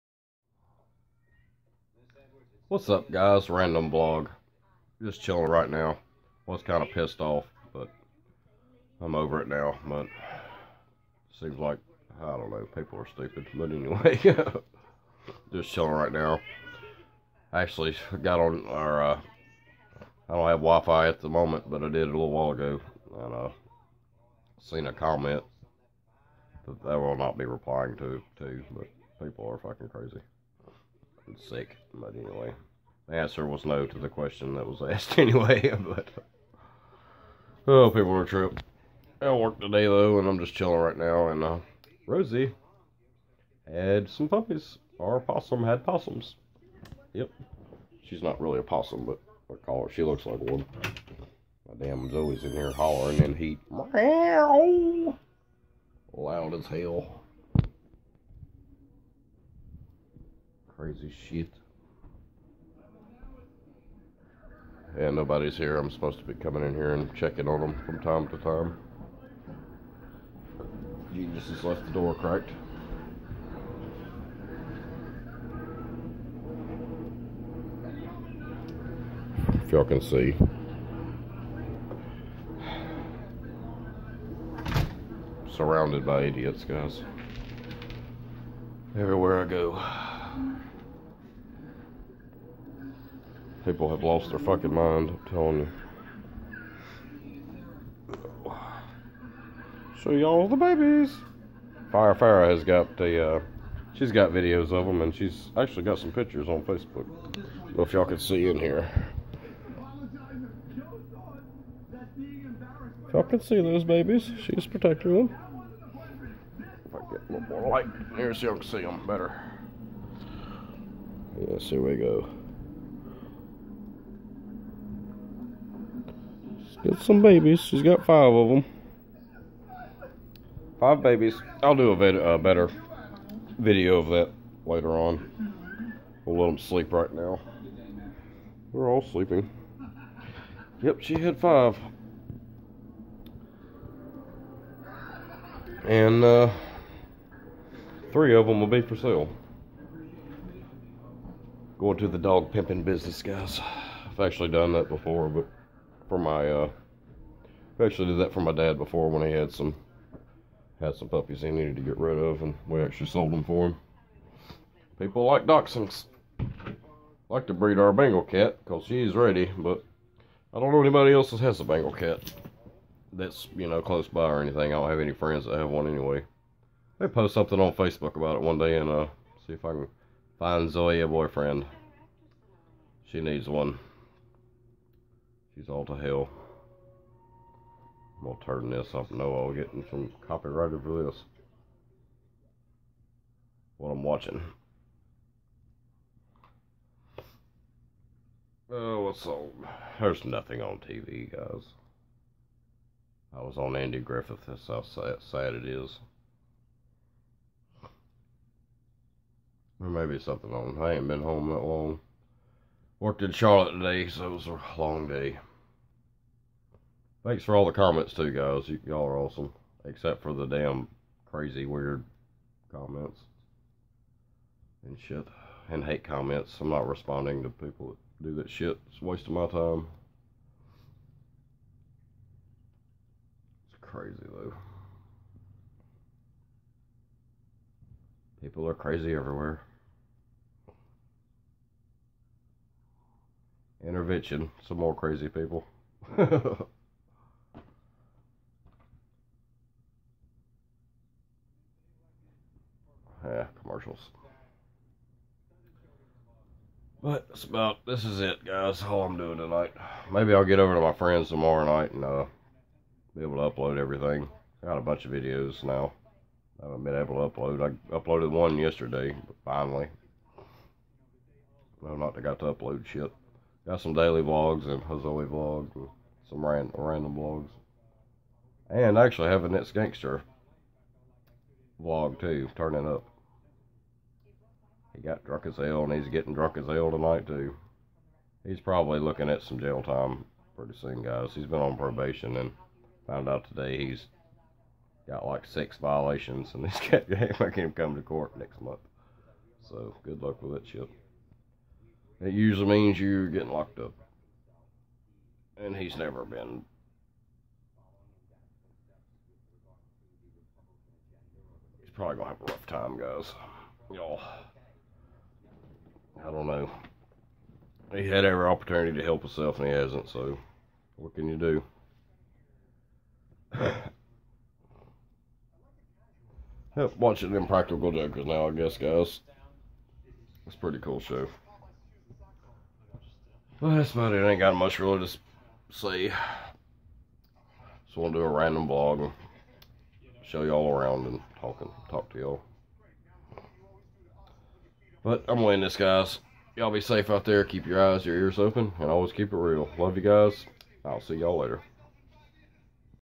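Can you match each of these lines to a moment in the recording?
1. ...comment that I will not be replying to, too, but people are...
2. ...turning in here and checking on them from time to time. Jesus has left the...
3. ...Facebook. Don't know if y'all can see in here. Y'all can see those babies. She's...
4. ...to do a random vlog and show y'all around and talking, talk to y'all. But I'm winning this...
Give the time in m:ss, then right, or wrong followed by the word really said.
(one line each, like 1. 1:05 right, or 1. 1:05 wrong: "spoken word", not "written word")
1. 0:24 right
2. 1:06 wrong: "coming", not "turning"
3. 1:46 right
4. 5:38 right.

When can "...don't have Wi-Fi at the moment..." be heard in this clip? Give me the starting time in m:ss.
0:20.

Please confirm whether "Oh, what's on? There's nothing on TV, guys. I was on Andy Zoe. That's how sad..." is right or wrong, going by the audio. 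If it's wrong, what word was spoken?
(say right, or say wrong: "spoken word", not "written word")
wrong: "Griffith", not "Zoe".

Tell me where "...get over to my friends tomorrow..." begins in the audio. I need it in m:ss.
4:20.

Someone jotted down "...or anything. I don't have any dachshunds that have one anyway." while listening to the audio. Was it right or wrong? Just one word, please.
wrong.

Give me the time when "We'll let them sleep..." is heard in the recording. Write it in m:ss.
2:16.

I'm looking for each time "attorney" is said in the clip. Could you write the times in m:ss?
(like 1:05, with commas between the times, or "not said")
not said.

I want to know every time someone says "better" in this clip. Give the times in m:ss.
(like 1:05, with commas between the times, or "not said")
1:59, 2:12.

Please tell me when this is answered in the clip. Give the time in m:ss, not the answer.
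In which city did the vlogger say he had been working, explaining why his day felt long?
3:33.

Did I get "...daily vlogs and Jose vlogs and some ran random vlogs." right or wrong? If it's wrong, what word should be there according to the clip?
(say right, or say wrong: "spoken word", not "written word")
right.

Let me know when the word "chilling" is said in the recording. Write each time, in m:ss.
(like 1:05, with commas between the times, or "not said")
0:05, 0:15, 0:40.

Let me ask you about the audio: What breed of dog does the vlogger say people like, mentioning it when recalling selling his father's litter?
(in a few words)
Dachshunds.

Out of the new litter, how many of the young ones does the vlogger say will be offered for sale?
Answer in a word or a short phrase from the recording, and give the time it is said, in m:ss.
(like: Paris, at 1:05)
3, at 2:28.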